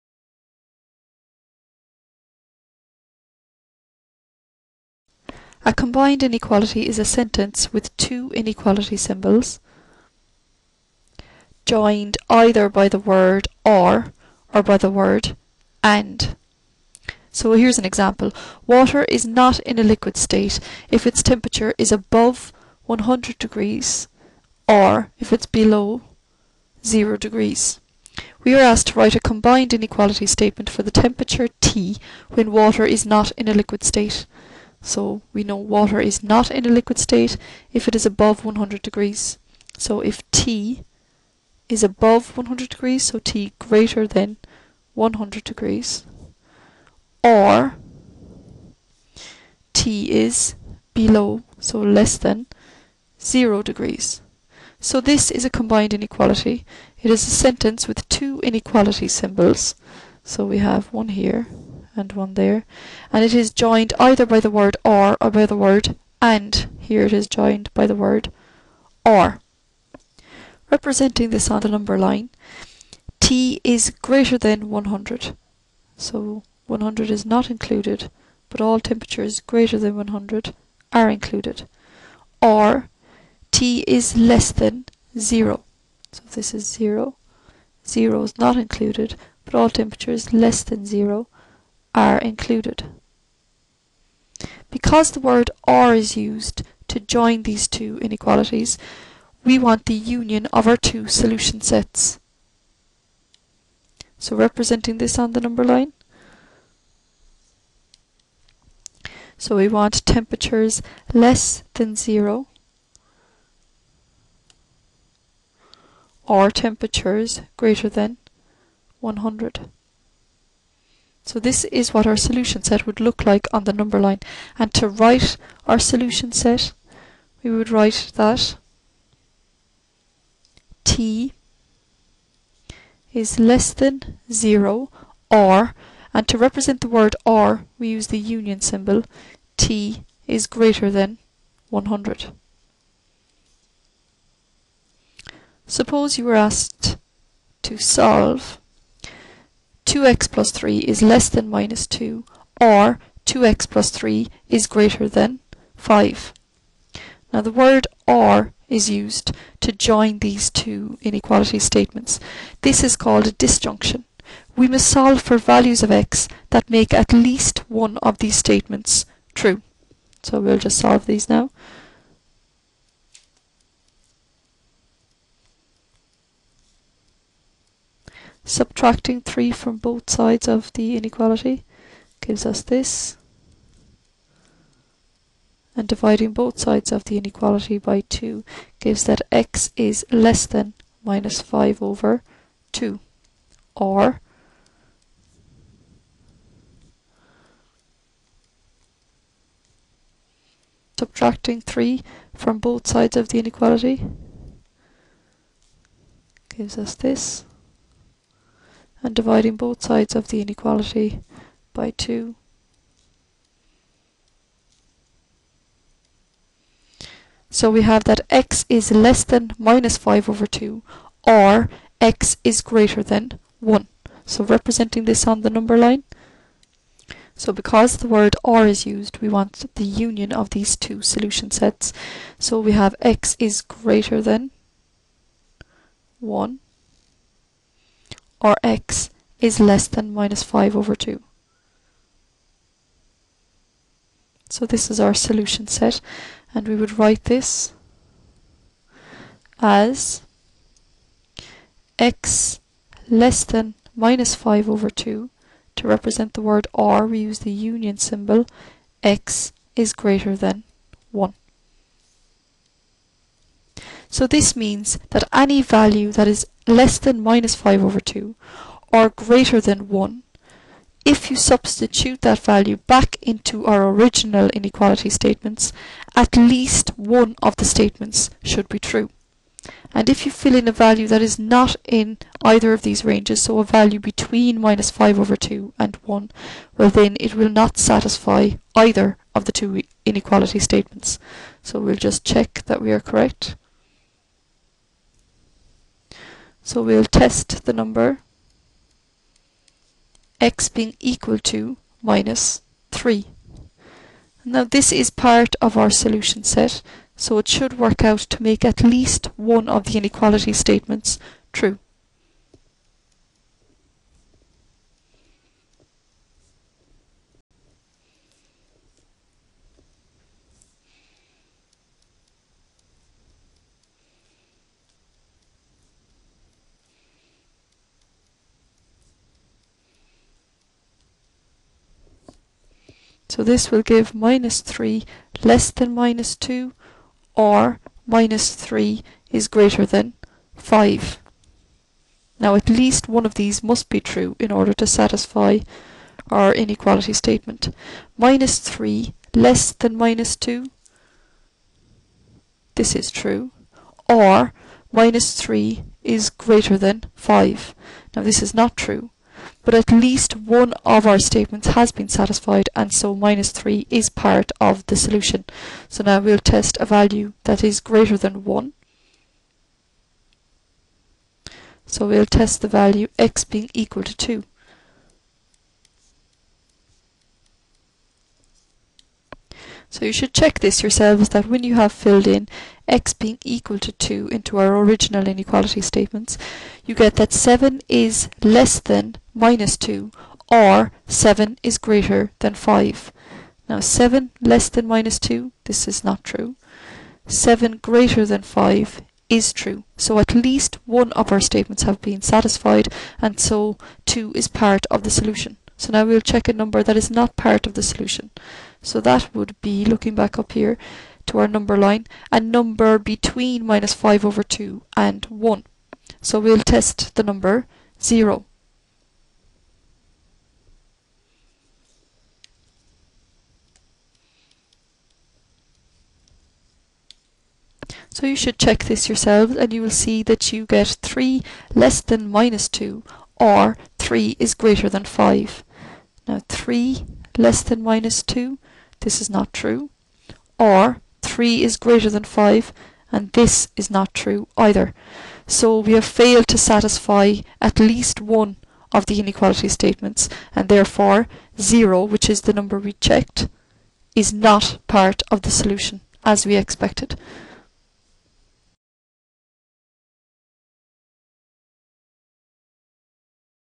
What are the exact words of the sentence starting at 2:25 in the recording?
Suppose you were asked to solve 2x plus 3 is less than minus 2 or 2x plus 3 is greater than 5.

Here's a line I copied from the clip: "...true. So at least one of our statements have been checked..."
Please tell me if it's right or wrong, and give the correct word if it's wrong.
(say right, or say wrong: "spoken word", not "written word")
wrong: "satisfied", not "checked".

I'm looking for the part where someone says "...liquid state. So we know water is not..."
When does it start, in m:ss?
0:33.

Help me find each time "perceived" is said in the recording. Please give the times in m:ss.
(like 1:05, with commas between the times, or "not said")
not said.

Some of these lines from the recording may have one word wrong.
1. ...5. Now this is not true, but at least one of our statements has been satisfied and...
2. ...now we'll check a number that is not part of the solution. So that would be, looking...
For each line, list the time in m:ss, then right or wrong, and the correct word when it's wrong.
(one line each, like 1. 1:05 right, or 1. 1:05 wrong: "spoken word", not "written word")
1. 5:57 right
2. 6:45 right.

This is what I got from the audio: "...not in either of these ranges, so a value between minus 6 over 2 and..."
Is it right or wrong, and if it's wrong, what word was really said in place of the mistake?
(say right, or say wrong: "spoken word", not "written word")
wrong: "5", not "6".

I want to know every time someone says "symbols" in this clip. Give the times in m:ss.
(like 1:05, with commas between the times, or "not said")
0:08, 0:59, 2:18, 4:17.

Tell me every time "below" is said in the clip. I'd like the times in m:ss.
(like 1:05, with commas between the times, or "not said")
0:25, 0:50.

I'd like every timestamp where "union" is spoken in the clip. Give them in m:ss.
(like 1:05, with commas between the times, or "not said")
1:39, 2:18, 3:49, 4:17.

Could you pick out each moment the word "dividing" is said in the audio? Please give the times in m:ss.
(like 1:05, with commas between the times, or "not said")
3:05, 3:29.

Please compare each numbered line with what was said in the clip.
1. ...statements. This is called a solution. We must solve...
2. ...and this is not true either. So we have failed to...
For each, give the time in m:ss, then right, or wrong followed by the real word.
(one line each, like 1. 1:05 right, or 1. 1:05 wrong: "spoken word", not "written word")
1. 2:41 wrong: "disjunction", not "solution"
2. 7:23 right.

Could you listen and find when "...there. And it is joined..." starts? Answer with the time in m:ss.
1:02.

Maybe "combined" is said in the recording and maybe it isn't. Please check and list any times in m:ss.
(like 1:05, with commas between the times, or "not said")
0:05, 0:29, 0:55.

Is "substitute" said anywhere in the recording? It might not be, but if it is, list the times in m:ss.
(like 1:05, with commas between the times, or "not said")
4:31.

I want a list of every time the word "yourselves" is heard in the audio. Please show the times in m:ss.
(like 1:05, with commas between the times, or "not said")
6:20, 7:09.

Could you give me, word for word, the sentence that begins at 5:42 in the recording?
Now at least one of these must be true in order to satisfy our inequality statement.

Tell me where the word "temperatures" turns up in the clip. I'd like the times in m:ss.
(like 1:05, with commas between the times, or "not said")
0:21, 0:30, 1:18, 1:29, 1:50, 1:56.